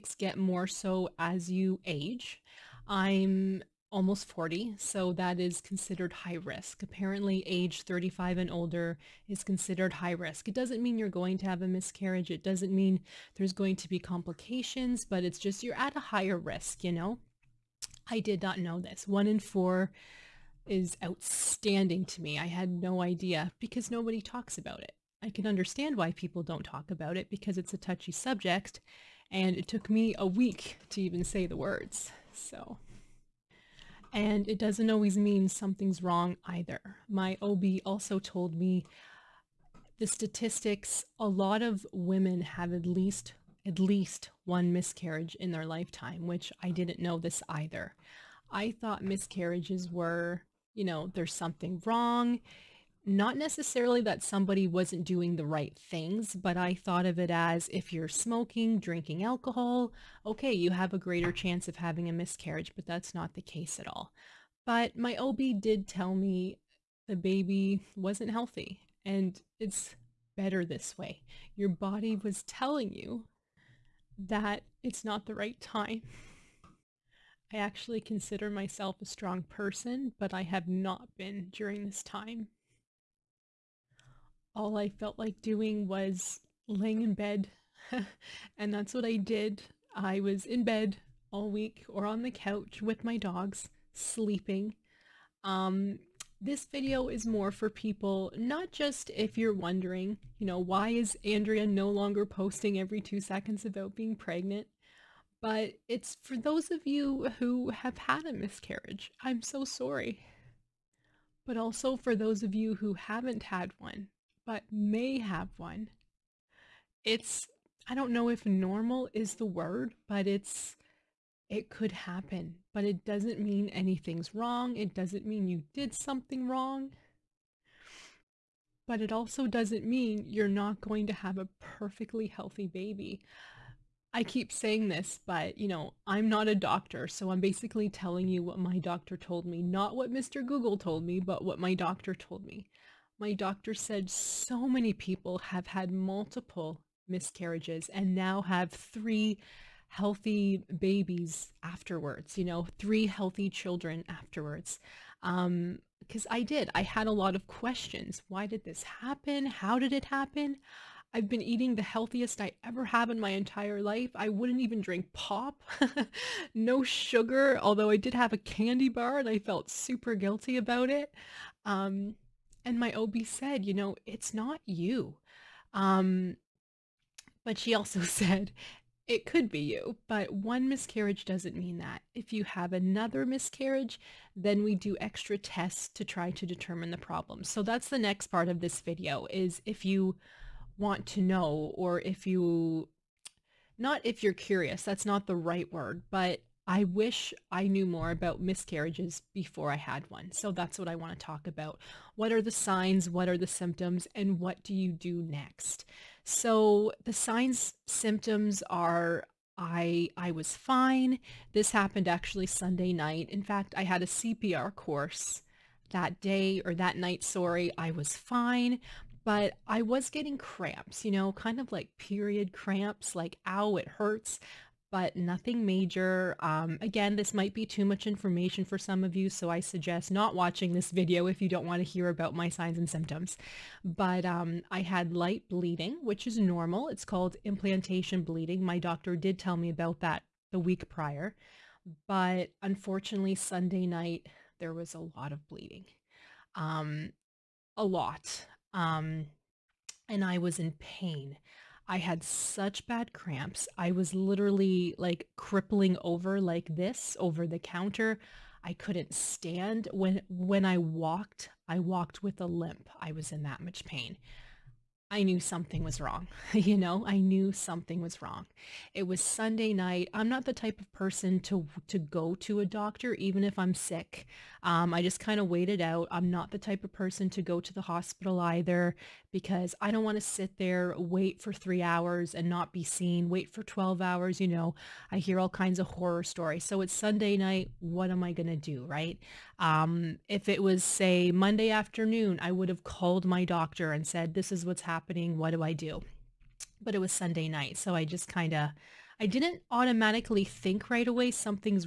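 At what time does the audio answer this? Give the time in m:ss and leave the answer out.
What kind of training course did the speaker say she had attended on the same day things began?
3:34.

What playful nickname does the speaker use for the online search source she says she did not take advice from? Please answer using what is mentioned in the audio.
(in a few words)
Mr. Google.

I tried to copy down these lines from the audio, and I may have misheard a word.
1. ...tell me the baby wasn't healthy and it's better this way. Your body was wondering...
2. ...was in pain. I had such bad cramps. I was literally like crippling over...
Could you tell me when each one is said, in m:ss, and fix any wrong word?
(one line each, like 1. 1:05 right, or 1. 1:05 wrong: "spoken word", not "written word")
1. 1:05 wrong: "telling", not "wondering"
2. 4:10 right.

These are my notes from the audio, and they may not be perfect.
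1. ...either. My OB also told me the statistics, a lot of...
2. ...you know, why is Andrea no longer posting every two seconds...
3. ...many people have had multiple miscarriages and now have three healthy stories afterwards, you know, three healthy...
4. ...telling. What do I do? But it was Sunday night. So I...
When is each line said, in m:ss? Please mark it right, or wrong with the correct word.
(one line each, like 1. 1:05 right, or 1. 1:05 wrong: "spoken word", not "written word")
1. 0:36 right
2. 1:40 right
3. 2:24 wrong: "babies", not "stories"
4. 4:54 wrong: "happening", not "telling".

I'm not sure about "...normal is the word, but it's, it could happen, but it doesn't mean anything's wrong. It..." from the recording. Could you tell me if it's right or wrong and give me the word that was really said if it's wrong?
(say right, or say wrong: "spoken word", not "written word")
right.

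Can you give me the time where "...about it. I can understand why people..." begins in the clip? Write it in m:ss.
0:24.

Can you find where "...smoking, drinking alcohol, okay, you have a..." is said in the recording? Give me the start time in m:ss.
0:58.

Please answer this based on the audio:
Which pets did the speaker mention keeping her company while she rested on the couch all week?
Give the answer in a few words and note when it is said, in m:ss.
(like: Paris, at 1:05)
dogs, at 1:33.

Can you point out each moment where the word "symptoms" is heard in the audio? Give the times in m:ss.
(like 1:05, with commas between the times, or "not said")
3:23, 3:27, 3:52.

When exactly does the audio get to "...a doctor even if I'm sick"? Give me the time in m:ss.
4:32.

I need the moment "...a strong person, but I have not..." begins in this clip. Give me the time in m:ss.
1:19.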